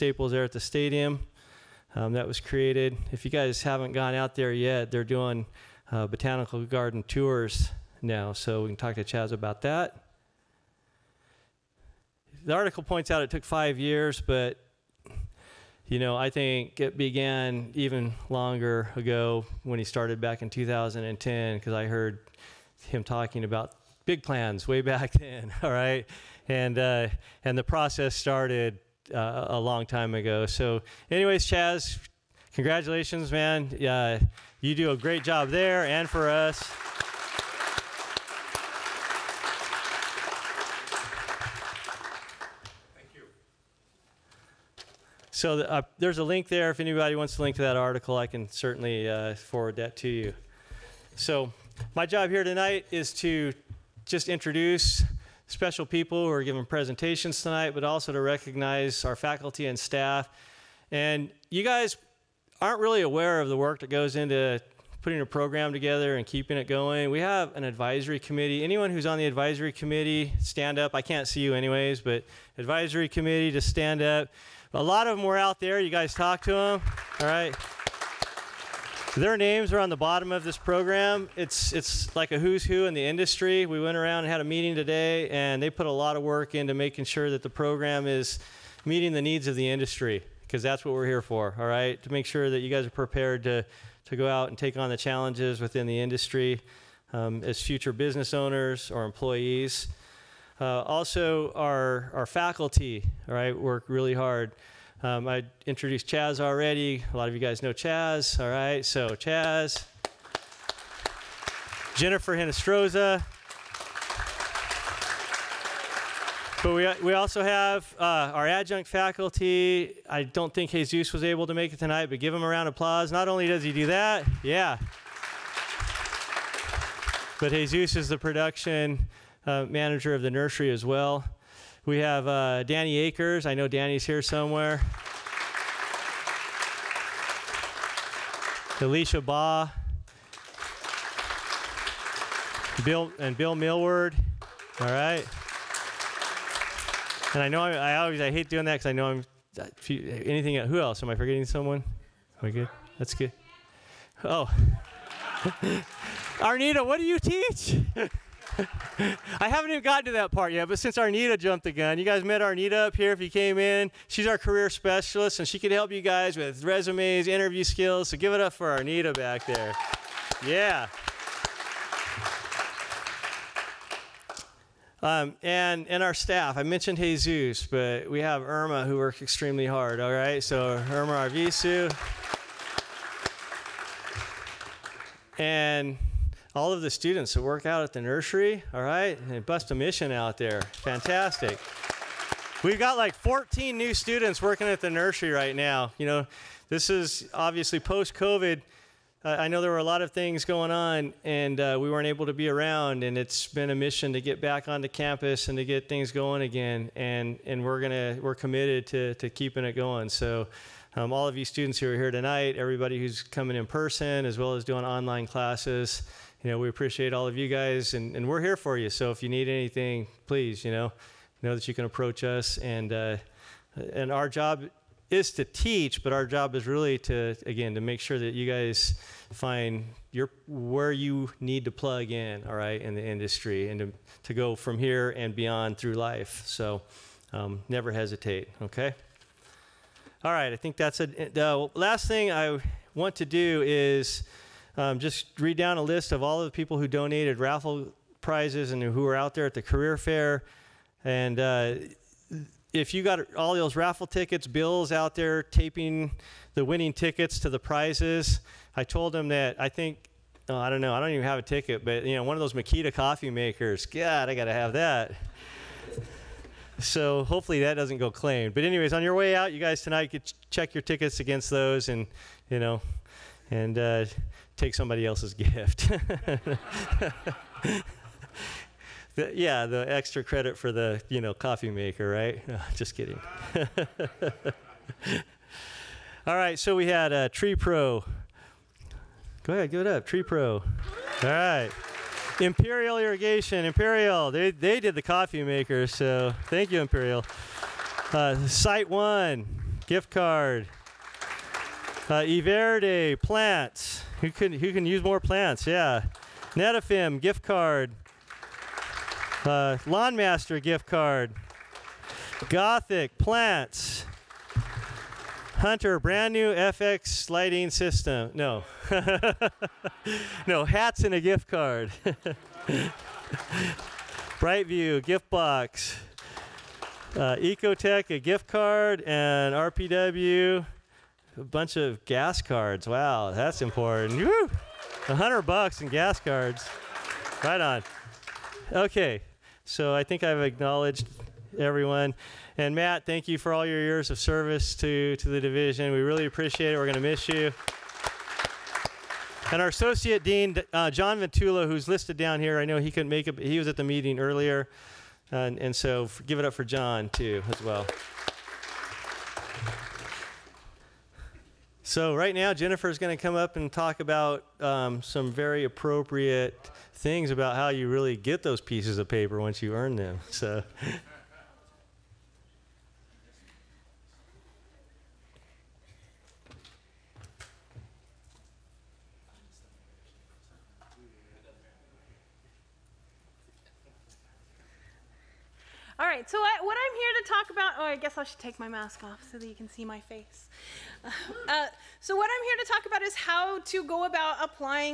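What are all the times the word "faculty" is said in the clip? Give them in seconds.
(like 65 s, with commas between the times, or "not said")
59 s, 102 s, 118 s.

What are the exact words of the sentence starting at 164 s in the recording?
She's our career specialist, and she can help you guys with resumes, interview skills.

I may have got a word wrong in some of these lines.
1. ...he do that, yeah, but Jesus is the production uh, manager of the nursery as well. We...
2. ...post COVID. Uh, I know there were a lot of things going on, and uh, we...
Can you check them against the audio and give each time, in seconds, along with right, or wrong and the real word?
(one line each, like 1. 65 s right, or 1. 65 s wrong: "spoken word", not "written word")
1. 123 s right
2. 197 s right.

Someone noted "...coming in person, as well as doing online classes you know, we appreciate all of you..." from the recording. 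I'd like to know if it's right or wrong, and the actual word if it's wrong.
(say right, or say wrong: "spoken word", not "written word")
right.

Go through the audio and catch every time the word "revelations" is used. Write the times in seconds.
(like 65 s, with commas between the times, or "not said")
not said.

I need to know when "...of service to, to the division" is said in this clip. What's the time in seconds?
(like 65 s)
344 s.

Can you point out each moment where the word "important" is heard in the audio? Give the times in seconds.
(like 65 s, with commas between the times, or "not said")
333 s.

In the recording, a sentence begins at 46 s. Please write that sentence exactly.
If anybody wants to link to that article, I can certainly uh, forward that to you.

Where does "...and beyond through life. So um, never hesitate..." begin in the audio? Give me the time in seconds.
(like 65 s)
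235 s.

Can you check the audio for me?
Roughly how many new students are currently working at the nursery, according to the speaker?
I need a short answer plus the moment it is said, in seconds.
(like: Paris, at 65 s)
14, at 193 s.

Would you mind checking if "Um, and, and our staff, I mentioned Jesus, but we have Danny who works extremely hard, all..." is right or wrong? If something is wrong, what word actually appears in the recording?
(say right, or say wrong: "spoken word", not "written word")
wrong: "Irma", not "Danny".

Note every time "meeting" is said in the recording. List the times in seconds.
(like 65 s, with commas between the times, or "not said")
84 s, 88 s, 353 s.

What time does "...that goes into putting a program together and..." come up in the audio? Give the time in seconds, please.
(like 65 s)
63 s.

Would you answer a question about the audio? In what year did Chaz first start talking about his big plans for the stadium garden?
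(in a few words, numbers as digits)
2010.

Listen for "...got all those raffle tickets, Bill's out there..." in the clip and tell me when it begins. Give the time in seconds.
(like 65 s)
253 s.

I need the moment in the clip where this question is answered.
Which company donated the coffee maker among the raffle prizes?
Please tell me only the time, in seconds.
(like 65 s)
292 s.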